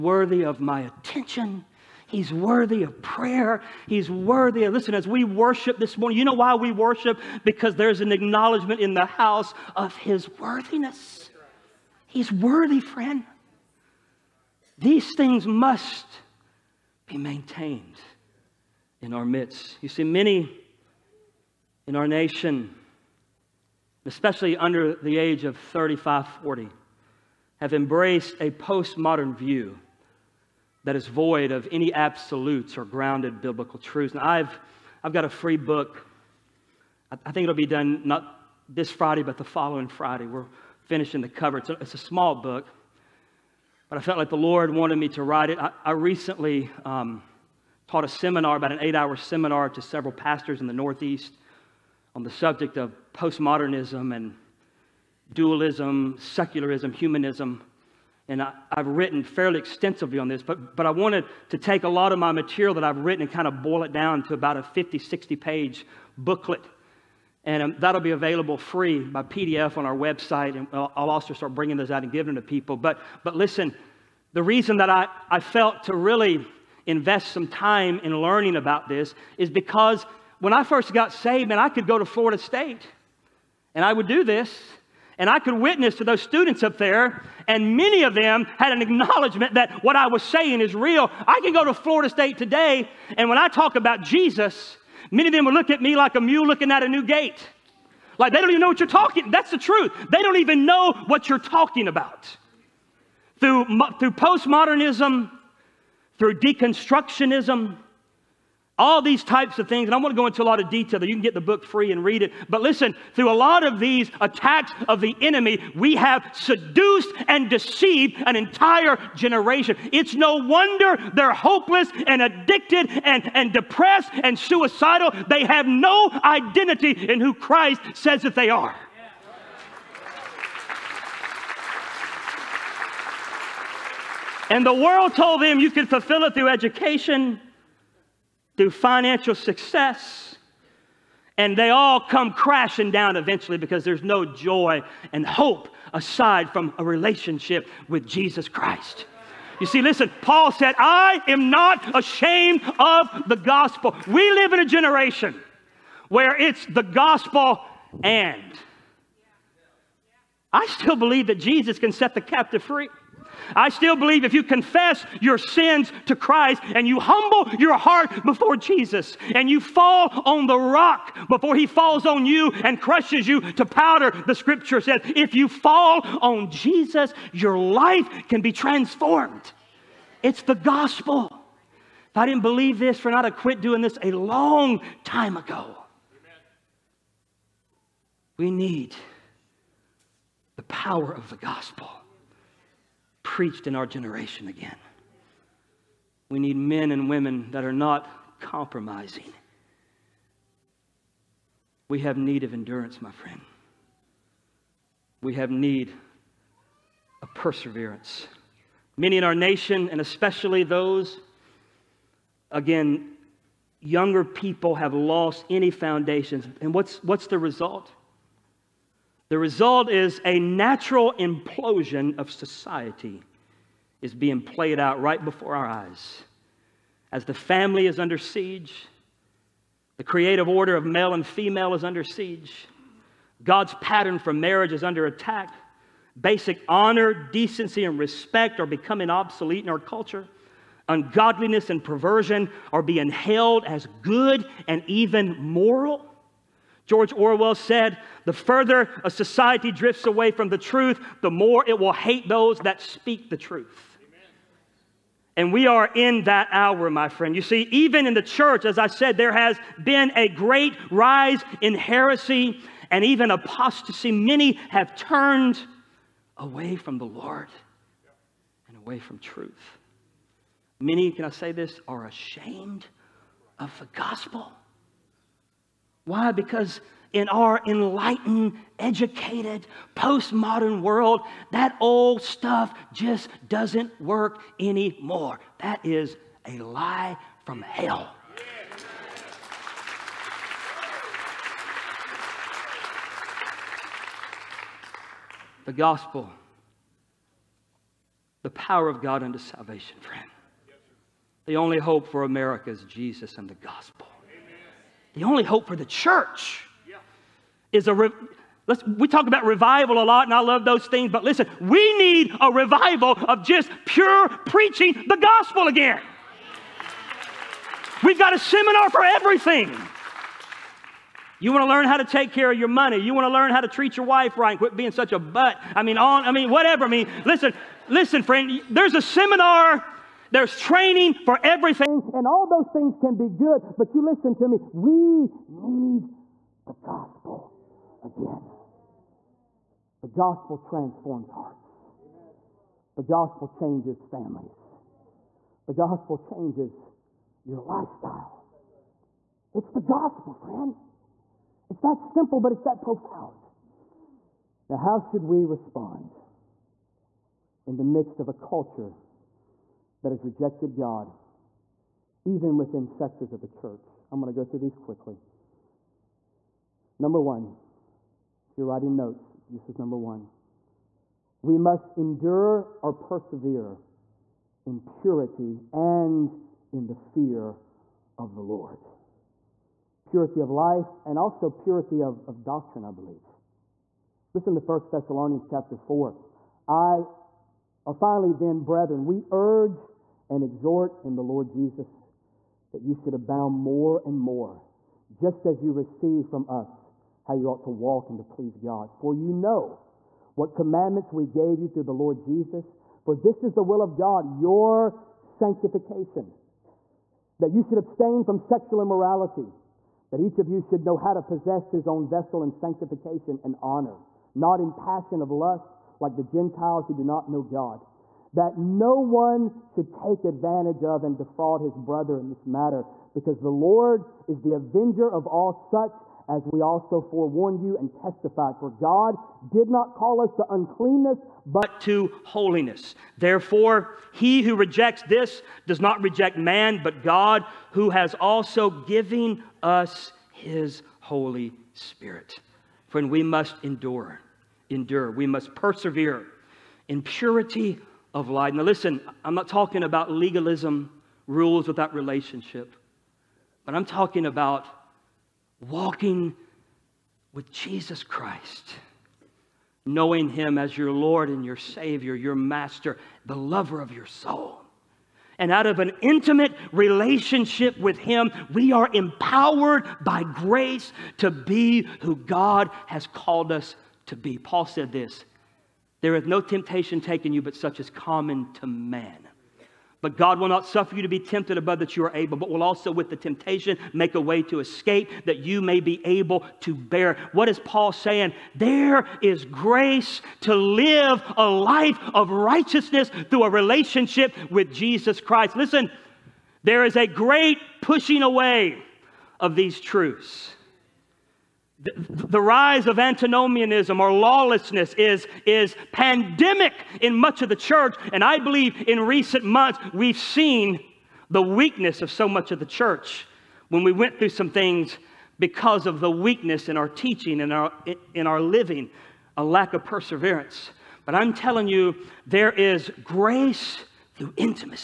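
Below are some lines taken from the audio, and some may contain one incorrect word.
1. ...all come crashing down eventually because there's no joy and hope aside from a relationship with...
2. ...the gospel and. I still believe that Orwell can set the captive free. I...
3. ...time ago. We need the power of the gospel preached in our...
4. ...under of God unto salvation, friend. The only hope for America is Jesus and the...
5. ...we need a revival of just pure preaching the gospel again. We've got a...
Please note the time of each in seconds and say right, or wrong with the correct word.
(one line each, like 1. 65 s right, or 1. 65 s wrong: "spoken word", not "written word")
1. 141 s right
2. 156 s wrong: "Jesus", not "Orwell"
3. 185 s right
4. 298 s wrong: "power", not "under"
5. 311 s right.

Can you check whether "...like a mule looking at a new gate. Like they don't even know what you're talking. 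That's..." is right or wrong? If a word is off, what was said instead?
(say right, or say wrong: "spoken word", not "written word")
right.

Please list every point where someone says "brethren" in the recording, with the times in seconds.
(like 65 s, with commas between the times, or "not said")
388 s.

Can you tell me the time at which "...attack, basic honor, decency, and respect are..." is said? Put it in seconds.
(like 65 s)
235 s.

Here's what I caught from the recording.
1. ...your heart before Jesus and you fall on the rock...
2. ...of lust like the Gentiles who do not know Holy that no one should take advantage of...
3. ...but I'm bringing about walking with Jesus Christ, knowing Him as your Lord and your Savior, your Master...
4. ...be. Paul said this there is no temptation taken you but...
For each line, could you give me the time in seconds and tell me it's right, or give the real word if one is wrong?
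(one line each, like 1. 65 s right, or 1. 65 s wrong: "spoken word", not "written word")
1. 167 s right
2. 415 s wrong: "God", not "Holy"
3. 453 s wrong: "talking", not "bringing"
4. 474 s right.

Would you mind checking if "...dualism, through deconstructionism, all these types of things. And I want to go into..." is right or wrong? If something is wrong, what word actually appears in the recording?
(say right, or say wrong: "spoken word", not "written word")
wrong: "postmodernism", not "dualism".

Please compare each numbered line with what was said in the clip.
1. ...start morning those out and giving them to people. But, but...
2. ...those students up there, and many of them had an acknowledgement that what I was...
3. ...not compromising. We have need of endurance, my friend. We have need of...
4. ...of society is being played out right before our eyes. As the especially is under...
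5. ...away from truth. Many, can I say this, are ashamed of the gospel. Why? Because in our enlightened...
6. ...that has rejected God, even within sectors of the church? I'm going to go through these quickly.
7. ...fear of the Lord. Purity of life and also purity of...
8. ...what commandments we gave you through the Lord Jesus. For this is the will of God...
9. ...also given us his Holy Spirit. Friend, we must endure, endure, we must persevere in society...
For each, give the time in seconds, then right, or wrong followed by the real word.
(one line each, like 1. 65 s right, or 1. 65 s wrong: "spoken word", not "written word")
1. 71 s wrong: "bringing", not "morning"
2. 86 s right
3. 197 s right
4. 222 s wrong: "family", not "especially"
5. 268 s right
6. 360 s right
7. 376 s right
8. 400 s right
9. 438 s wrong: "purity", not "society".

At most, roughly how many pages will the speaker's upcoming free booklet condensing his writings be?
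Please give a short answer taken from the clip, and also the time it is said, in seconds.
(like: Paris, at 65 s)
60, at 64 s.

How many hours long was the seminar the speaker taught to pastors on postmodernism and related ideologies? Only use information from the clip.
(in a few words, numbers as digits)
8.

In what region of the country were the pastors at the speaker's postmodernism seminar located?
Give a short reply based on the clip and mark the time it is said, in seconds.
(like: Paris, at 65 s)
Northeast, at 50 s.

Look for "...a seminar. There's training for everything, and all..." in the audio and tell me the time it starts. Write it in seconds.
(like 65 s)
328 s.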